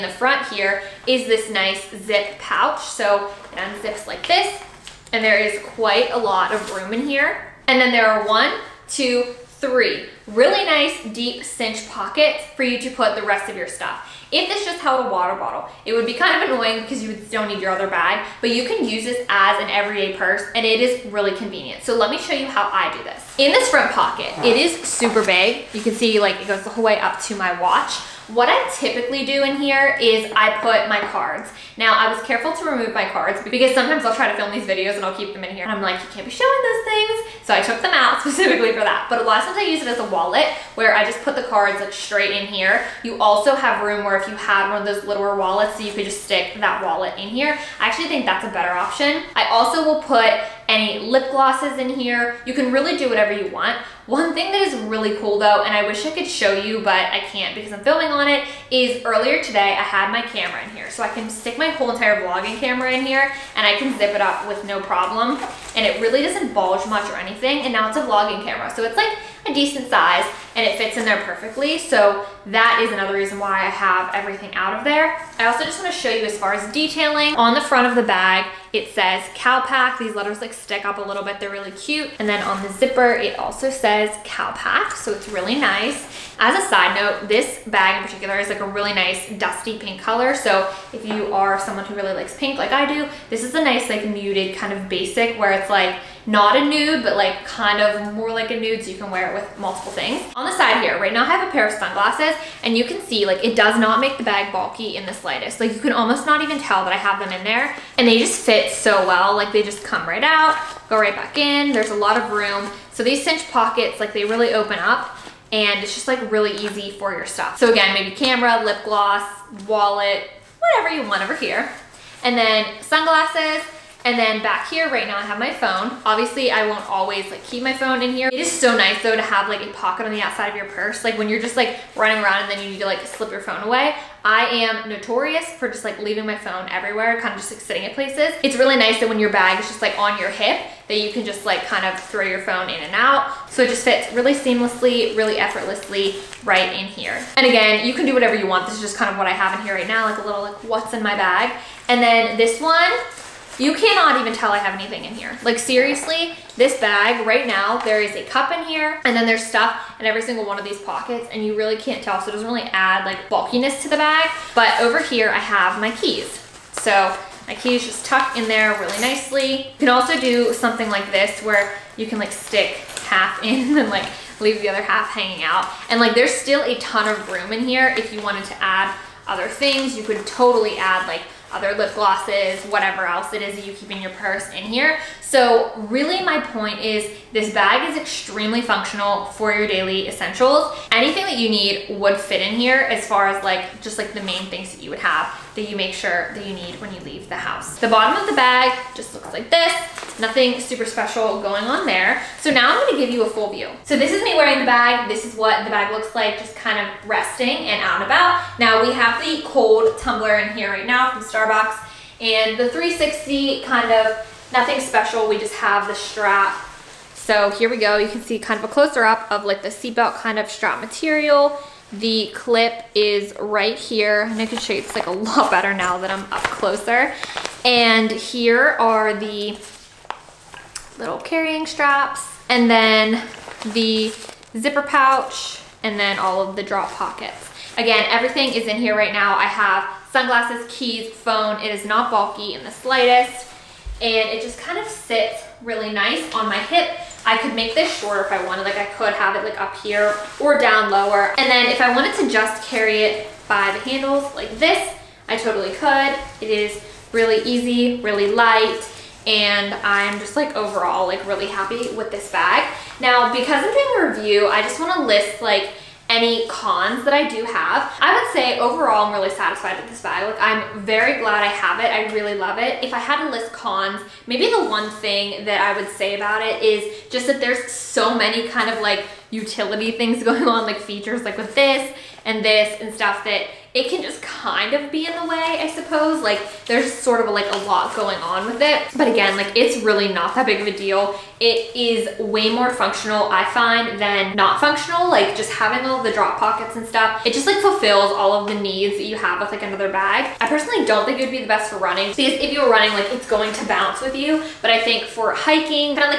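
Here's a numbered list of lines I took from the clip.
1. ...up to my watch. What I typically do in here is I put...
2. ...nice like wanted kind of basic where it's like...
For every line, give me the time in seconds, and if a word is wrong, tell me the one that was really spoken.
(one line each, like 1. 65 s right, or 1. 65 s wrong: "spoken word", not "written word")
1. 26 s right
2. 93 s wrong: "muted", not "wanted".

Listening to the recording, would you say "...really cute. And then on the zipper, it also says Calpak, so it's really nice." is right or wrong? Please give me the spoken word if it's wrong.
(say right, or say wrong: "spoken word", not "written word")
right.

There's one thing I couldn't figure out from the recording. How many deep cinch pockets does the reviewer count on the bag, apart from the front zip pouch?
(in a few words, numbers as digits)
3.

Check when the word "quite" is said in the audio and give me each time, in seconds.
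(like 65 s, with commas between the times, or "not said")
5 s.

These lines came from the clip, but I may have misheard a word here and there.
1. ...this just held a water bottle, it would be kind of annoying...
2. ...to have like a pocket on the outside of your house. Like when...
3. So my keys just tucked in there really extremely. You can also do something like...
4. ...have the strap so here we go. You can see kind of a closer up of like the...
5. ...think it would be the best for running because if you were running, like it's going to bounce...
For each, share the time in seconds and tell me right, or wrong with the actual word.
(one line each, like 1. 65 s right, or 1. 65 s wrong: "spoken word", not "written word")
1. 14 s right
2. 129 s wrong: "purse", not "house"
3. 166 s wrong: "nicely", not "extremely"
4. 215 s right
5. 301 s right.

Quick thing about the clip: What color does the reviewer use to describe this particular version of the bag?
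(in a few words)
Dusty pink.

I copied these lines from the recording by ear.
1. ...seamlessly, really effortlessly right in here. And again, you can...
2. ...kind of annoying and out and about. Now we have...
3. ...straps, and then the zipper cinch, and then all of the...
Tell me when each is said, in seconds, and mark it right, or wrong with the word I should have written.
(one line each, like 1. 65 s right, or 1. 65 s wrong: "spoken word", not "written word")
1. 144 s right
2. 206 s wrong: "resting", not "annoying"
3. 231 s wrong: "pouch", not "cinch".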